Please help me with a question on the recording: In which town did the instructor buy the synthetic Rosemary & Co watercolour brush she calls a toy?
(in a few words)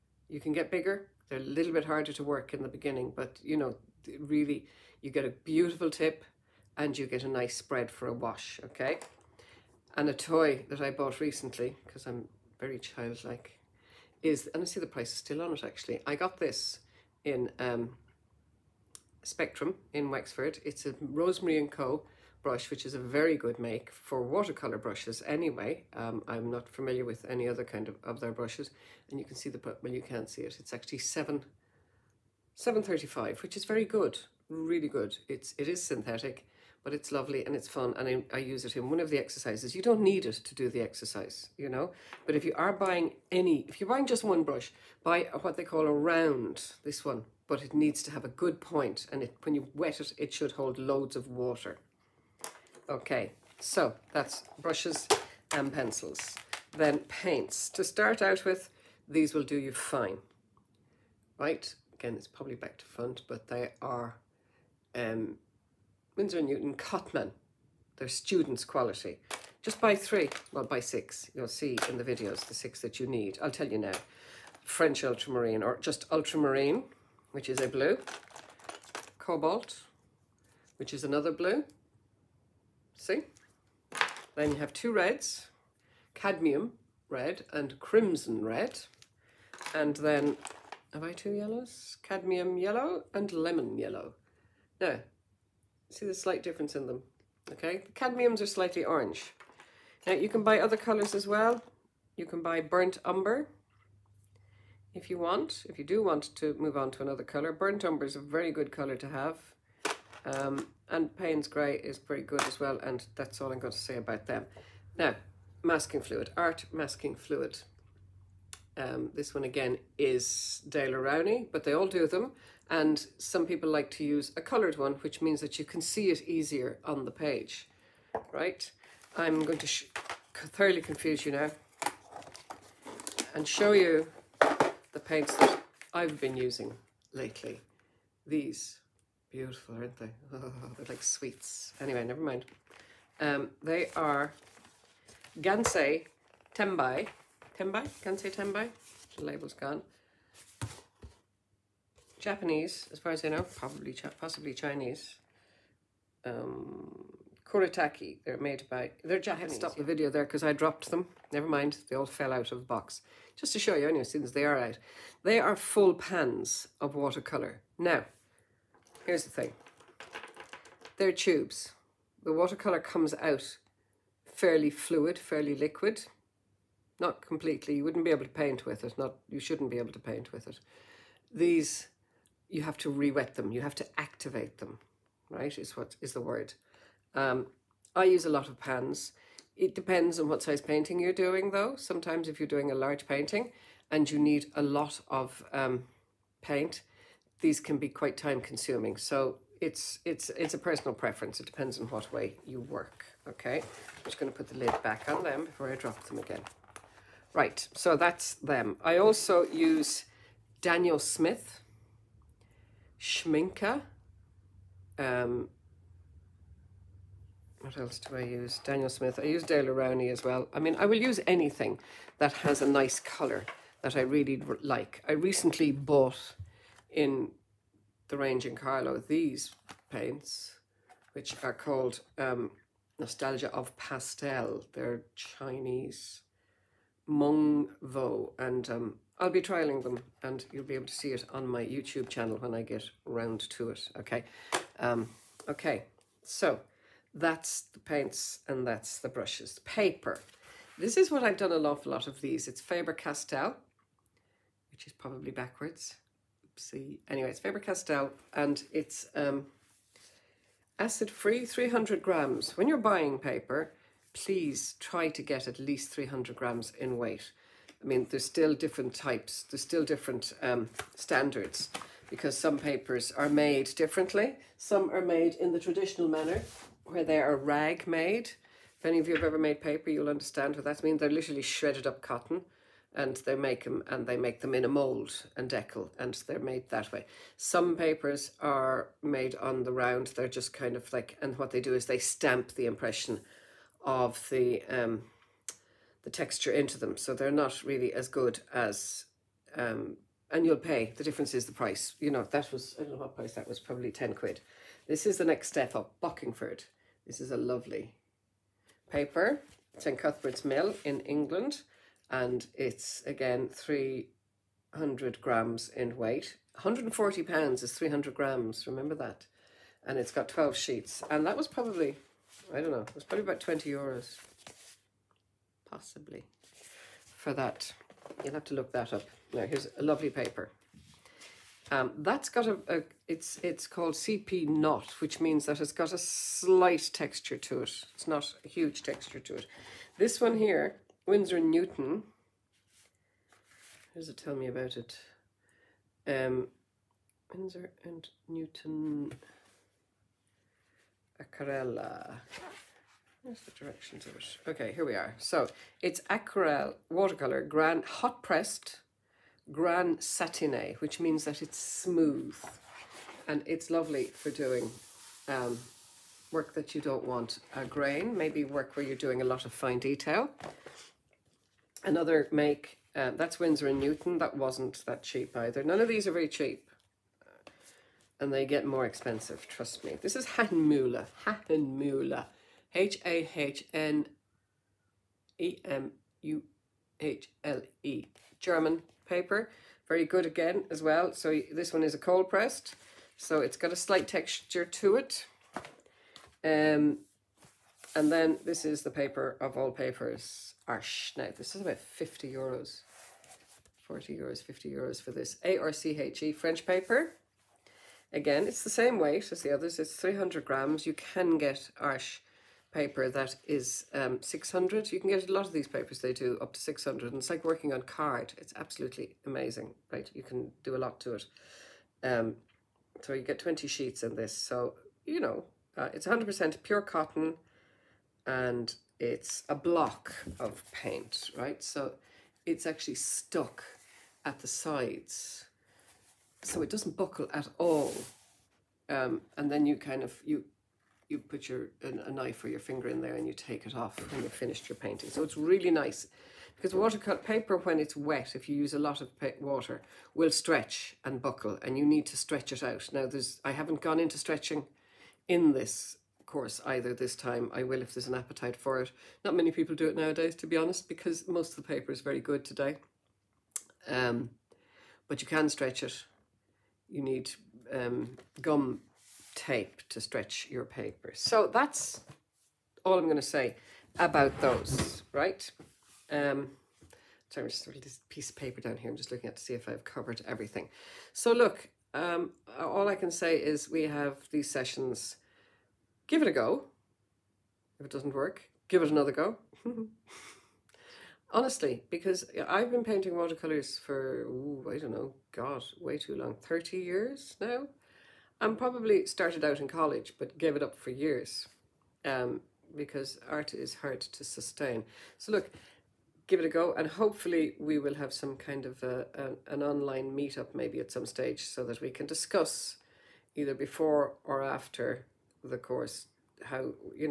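Wexford.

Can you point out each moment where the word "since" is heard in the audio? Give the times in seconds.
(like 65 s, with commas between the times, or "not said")
164 s.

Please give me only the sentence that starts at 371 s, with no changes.
Another make, uh, that's Winsor & Newton, that wasn't that cheap either.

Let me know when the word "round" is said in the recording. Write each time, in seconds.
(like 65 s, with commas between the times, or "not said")
45 s, 243 s, 289 s.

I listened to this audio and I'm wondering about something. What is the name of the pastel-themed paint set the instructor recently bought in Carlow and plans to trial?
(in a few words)
Nostalgia of Pastel.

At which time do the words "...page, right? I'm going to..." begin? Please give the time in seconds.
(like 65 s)
127 s.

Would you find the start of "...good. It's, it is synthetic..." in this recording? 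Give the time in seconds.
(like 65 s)
34 s.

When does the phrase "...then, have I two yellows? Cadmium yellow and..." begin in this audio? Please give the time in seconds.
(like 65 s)
89 s.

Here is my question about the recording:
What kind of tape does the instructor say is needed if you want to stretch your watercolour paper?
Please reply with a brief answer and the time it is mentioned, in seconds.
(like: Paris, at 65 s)
gum tape, at 468 s.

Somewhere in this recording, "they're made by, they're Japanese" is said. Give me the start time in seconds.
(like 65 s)
158 s.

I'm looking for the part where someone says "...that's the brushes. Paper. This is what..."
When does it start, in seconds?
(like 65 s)
248 s.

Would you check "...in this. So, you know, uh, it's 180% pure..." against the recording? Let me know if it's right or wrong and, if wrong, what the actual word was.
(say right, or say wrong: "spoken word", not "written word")
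wrong: "100", not "180".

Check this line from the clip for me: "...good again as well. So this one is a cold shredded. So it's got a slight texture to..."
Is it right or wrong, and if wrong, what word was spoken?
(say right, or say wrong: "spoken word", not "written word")
wrong: "pressed", not "shredded".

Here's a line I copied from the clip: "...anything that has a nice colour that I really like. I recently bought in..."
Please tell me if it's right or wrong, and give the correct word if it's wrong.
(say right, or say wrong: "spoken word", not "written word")
right.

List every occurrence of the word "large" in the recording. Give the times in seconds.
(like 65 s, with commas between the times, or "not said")
192 s.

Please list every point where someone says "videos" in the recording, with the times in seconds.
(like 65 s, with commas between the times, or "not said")
72 s, 159 s.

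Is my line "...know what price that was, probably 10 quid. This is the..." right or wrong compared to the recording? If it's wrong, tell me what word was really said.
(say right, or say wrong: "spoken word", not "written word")
right.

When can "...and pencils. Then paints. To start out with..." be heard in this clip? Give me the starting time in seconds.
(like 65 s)
55 s.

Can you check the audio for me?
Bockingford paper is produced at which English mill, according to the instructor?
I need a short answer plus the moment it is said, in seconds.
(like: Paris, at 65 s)
Cuthbert's Mill, at 309 s.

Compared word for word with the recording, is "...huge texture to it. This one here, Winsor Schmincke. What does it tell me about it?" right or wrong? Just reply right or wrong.
wrong.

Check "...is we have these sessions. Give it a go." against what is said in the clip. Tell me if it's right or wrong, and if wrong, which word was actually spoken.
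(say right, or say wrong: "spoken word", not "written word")
right.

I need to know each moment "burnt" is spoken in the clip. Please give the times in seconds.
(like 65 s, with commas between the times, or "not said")
102 s, 107 s.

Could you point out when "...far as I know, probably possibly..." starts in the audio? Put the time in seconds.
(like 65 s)
152 s.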